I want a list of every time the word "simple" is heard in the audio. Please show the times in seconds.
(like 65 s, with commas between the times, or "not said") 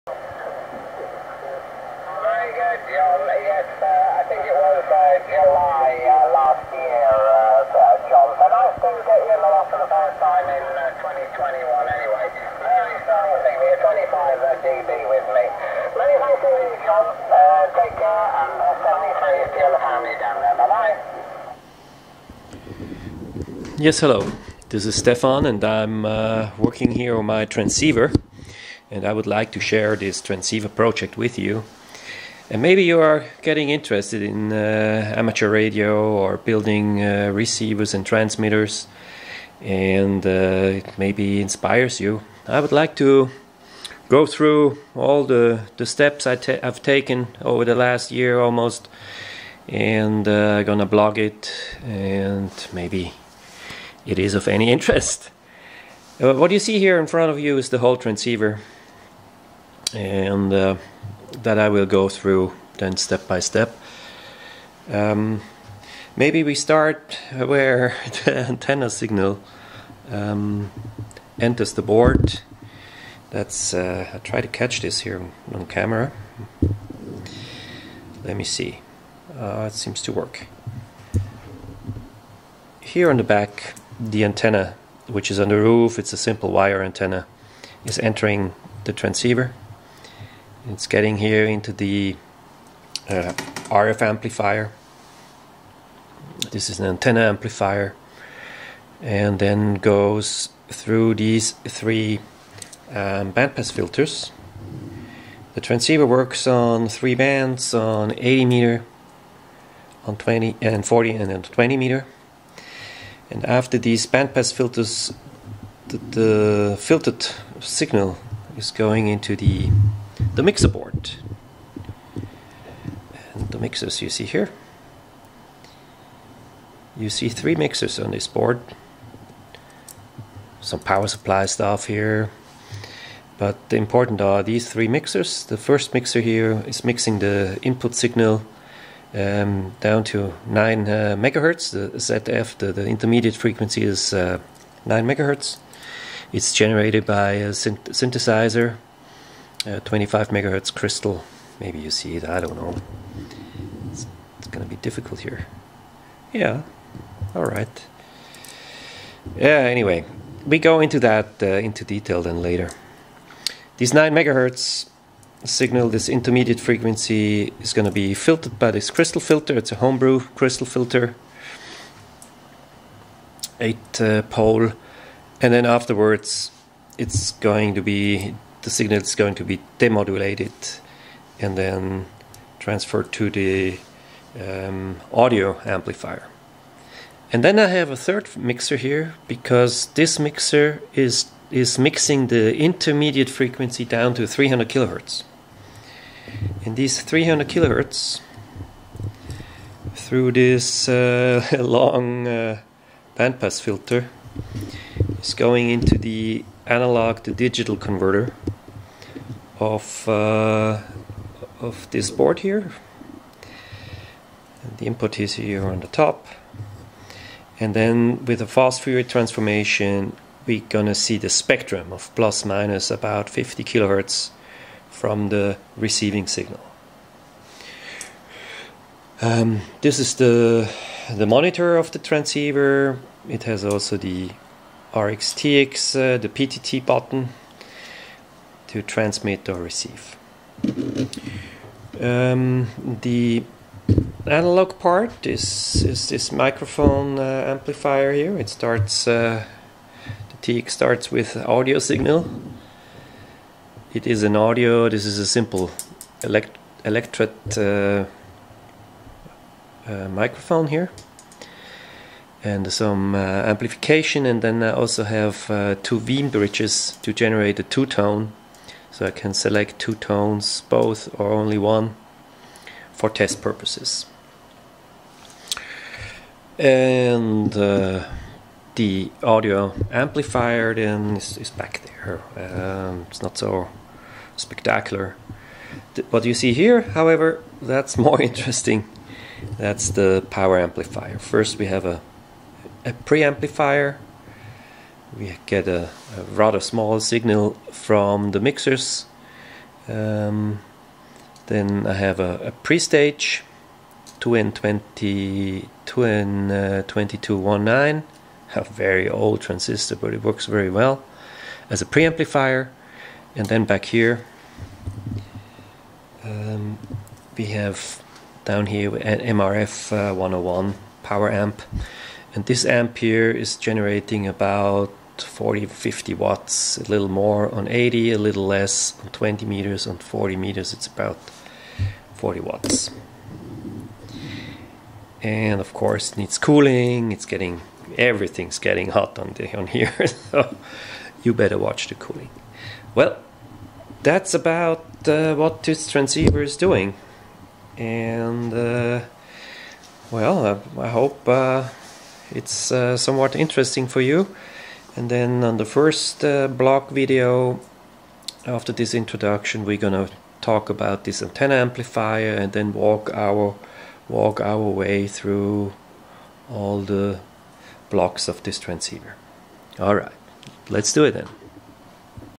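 86 s, 255 s.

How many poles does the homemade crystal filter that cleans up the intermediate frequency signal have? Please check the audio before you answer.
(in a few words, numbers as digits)
8.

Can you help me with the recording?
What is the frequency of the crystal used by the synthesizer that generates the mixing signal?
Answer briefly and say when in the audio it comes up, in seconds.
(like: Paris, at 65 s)
25 megahertz, at 149 s.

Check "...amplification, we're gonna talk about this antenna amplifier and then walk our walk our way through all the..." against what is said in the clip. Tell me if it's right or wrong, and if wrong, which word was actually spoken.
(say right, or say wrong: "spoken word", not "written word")
wrong: "introduction", not "amplification".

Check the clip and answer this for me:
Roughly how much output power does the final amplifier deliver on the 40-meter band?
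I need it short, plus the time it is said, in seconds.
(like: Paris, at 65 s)
40 watts, at 332 s.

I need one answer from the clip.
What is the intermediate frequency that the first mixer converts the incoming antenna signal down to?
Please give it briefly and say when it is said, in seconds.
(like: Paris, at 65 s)
9 megahertz, at 140 s.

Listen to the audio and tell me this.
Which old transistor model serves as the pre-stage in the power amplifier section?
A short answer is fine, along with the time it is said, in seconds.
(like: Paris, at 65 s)
2N2219, at 305 s.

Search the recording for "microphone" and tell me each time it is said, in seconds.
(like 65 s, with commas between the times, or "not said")
246 s, 260 s.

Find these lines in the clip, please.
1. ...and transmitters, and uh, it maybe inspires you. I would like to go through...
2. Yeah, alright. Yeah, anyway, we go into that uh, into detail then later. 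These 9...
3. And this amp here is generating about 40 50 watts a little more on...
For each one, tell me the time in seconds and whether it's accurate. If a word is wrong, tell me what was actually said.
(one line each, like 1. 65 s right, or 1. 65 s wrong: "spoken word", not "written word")
1. 37 s right
2. 156 s right
3. 322 s right.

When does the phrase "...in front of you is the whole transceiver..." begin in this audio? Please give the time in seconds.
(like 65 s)
56 s.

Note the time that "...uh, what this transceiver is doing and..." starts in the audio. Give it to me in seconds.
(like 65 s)
345 s.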